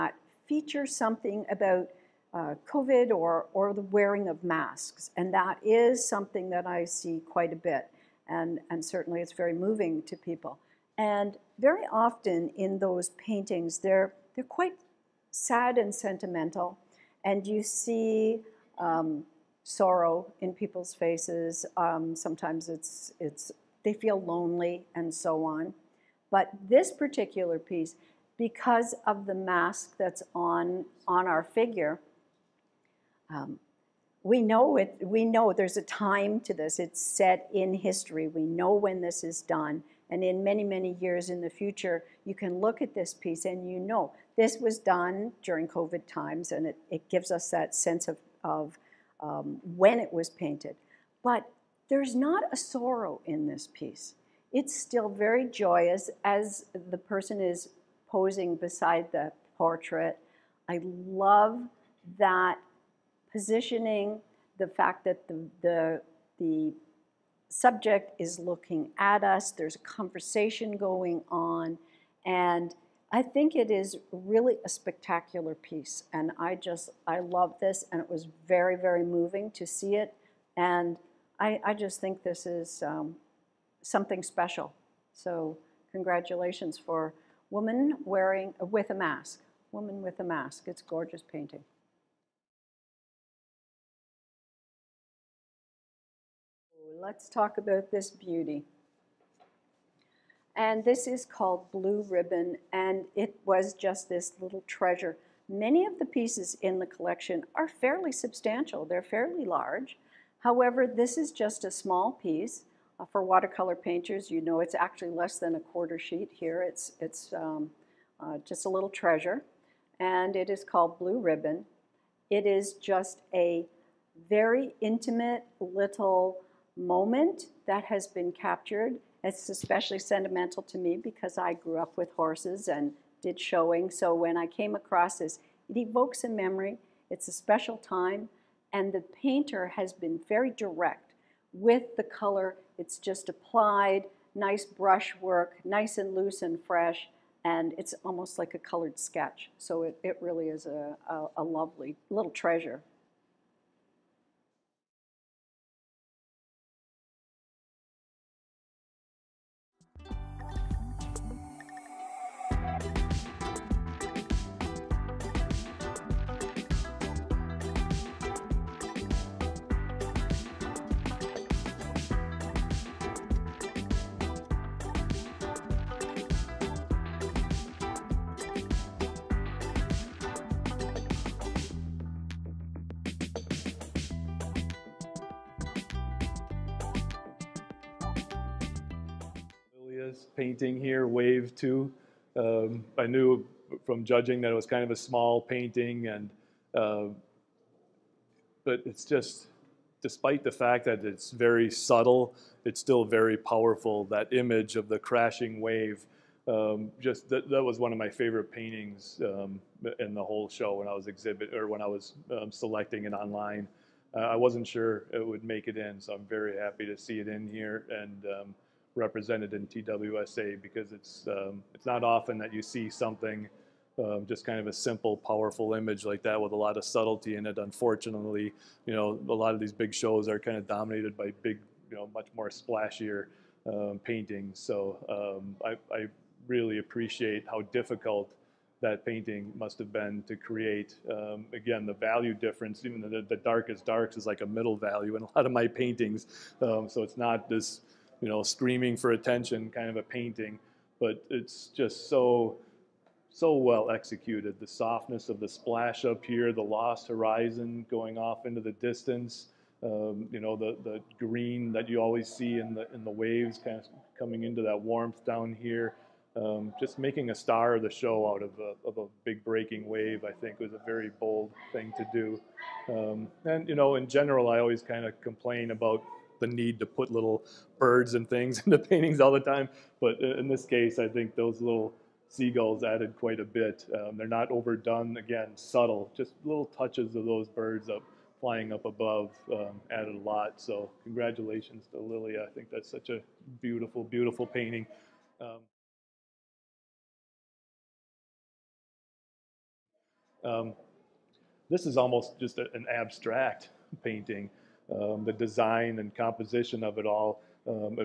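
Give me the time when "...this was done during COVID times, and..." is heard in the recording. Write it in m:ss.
0:44.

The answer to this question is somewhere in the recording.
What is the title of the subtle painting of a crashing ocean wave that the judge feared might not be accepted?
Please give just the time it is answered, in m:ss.
3:11.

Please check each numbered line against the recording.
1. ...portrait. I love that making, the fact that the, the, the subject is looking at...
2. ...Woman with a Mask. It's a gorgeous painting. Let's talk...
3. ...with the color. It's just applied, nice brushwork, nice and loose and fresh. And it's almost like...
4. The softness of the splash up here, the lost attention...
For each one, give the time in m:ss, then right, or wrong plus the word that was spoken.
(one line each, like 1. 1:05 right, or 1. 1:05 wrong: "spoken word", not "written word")
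1. 0:59 wrong: "positioning", not "making"
2. 1:29 right
3. 2:21 right
4. 4:14 wrong: "horizon", not "attention".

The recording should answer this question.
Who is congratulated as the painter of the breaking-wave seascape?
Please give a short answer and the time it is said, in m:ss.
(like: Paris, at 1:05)
Lilia, at 4:51.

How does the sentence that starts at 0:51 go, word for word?
But there's not a sorrow in this piece.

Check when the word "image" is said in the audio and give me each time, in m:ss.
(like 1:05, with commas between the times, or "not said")
3:24, 3:45.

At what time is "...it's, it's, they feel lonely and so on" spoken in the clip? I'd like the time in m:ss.
0:22.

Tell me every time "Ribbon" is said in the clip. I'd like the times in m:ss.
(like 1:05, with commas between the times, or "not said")
1:42, 2:01.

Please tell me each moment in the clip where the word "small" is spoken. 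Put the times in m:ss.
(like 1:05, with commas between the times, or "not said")
1:51, 3:14.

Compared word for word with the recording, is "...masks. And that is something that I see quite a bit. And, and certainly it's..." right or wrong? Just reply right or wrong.
right.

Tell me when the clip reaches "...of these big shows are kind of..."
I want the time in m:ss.
3:49.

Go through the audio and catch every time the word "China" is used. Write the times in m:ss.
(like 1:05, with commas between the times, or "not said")
not said.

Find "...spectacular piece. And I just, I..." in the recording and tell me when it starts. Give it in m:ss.
1:14.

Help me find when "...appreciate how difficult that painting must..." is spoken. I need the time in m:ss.
3:56.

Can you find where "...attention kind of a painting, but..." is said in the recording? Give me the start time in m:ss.
4:09.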